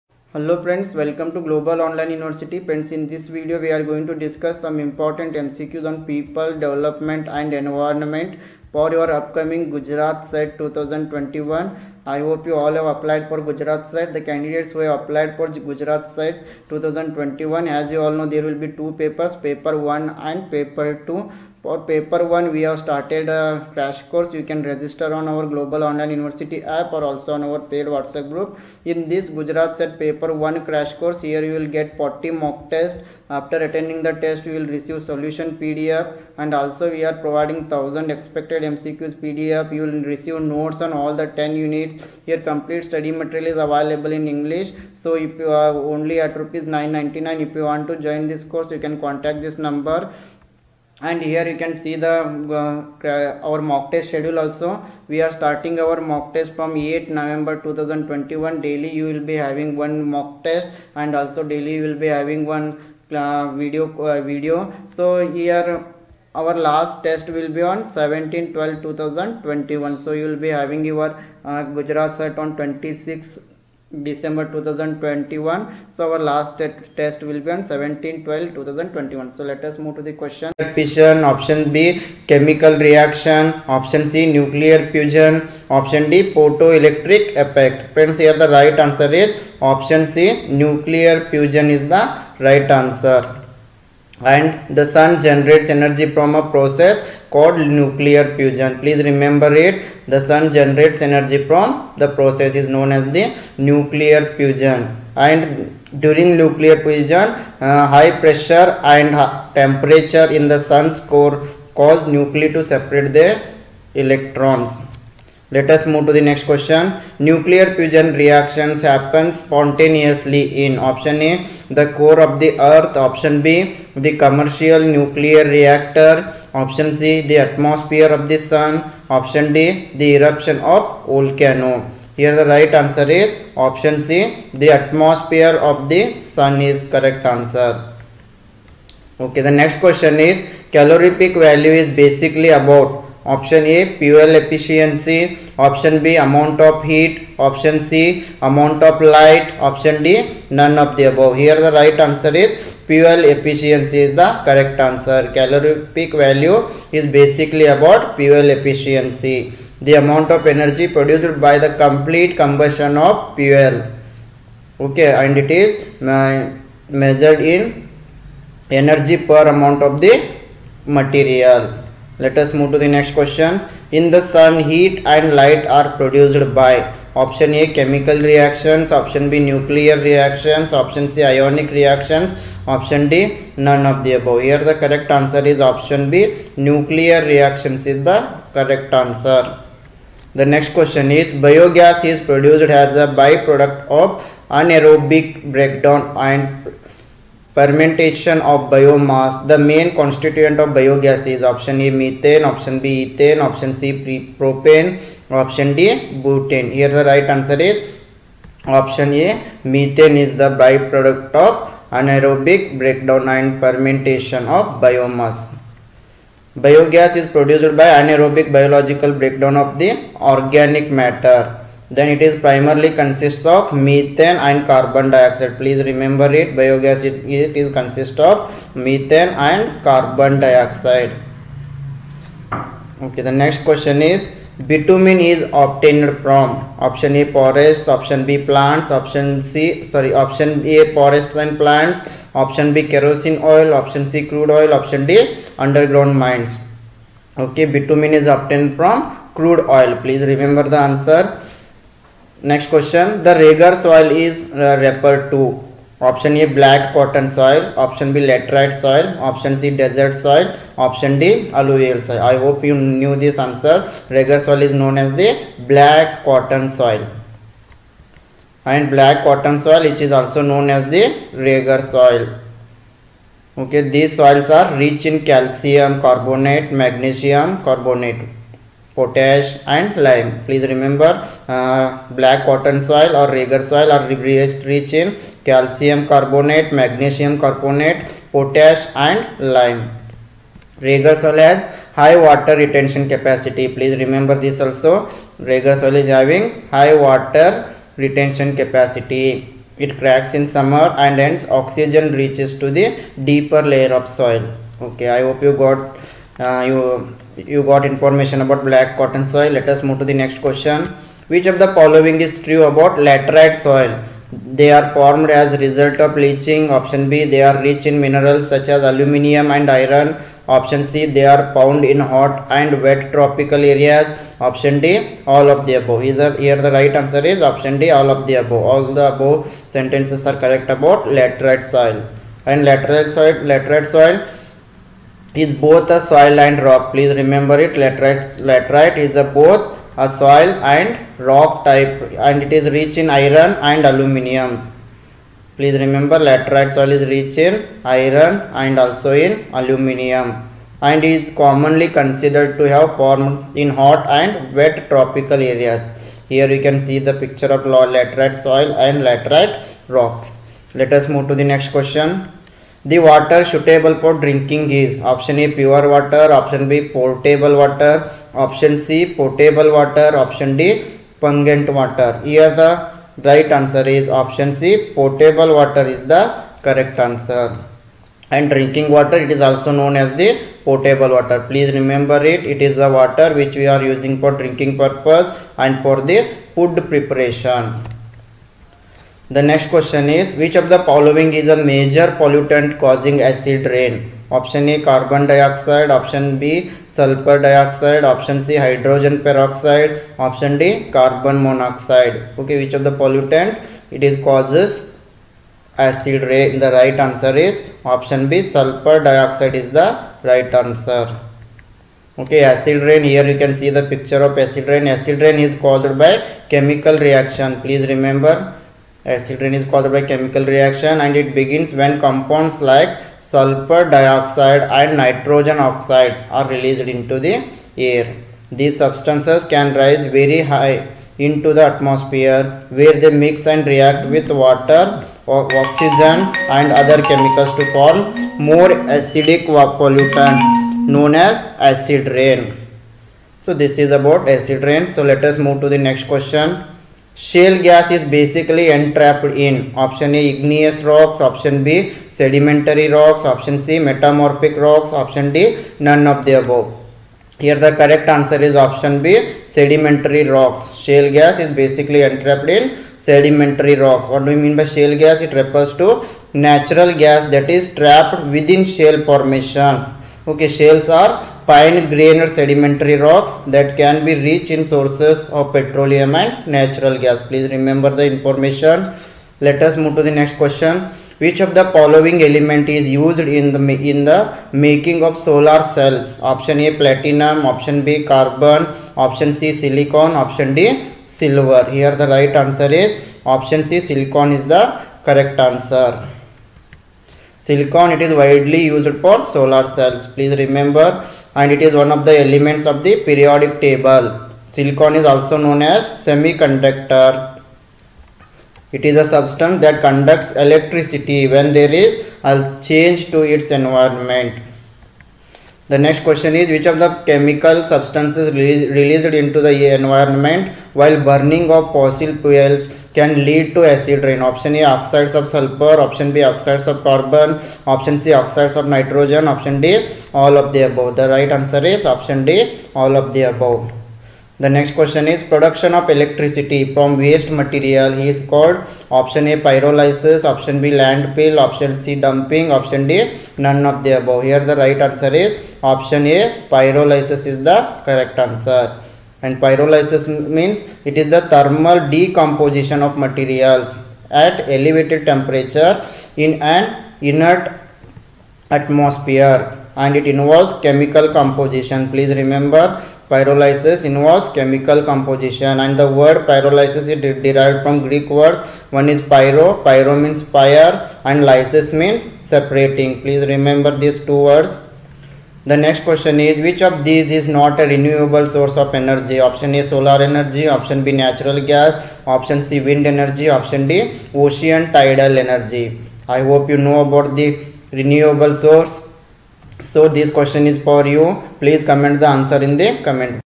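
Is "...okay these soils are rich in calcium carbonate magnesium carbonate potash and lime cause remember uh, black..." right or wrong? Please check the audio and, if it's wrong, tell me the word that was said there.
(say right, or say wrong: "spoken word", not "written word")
wrong: "please", not "cause".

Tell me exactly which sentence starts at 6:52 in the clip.
Okay, acid rain here you can see the picture of acid rain.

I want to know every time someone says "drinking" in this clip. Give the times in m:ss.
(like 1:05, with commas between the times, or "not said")
6:04, 6:18, 6:24.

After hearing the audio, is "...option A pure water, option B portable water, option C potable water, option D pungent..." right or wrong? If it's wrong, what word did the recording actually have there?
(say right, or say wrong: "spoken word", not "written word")
right.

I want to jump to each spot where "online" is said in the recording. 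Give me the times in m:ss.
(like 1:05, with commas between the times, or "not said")
0:01, 0:25.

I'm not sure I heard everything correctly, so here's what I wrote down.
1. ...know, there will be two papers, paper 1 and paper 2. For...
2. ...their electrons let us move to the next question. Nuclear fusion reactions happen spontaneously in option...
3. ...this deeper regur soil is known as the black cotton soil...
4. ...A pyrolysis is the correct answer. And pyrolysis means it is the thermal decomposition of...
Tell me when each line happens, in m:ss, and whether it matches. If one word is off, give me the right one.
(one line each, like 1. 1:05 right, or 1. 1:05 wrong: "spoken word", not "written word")
1. 0:18 right
2. 1:53 right
3. 4:23 wrong: "answer", not "deeper"
4. 9:06 right.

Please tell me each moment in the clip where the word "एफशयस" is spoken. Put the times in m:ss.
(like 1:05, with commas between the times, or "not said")
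2:24, 2:33, 2:38.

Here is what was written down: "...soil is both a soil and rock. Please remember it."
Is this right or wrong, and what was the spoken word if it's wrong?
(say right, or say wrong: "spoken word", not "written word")
right.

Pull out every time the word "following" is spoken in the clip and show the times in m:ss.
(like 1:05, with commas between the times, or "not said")
5:11, 6:30, 8:01.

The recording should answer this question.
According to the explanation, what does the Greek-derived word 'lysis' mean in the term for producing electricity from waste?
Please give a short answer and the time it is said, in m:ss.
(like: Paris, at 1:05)
Separating, at 9:32.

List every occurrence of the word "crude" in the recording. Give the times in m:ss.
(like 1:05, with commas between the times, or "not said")
4:04, 4:09.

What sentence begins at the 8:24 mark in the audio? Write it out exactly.
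Silicon is also known as semiconductor.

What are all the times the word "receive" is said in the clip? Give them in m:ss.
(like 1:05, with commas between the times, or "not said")
0:34, 0:40.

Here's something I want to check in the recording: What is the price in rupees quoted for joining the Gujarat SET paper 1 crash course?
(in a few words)
999.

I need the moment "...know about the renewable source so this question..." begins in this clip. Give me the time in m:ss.
9:46.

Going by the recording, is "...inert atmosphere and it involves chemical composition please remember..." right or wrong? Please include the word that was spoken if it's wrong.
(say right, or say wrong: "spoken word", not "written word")
right.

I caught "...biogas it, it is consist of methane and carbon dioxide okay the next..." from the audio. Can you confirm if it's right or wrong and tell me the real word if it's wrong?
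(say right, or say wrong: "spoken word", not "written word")
right.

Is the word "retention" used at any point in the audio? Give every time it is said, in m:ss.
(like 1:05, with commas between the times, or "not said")
4:52, 4:57.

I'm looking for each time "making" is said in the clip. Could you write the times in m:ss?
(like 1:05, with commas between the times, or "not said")
8:04.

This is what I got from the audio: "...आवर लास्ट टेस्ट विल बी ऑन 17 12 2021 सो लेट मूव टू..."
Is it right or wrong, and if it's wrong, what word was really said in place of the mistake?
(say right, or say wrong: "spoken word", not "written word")
right.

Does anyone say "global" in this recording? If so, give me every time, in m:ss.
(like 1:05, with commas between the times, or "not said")
0:01, 0:25.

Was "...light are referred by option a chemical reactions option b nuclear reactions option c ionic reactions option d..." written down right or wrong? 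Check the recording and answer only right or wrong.
wrong.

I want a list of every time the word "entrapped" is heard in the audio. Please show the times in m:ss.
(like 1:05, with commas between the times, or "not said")
7:28, 7:42.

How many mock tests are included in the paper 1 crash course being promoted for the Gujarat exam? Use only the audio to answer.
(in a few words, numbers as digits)
40.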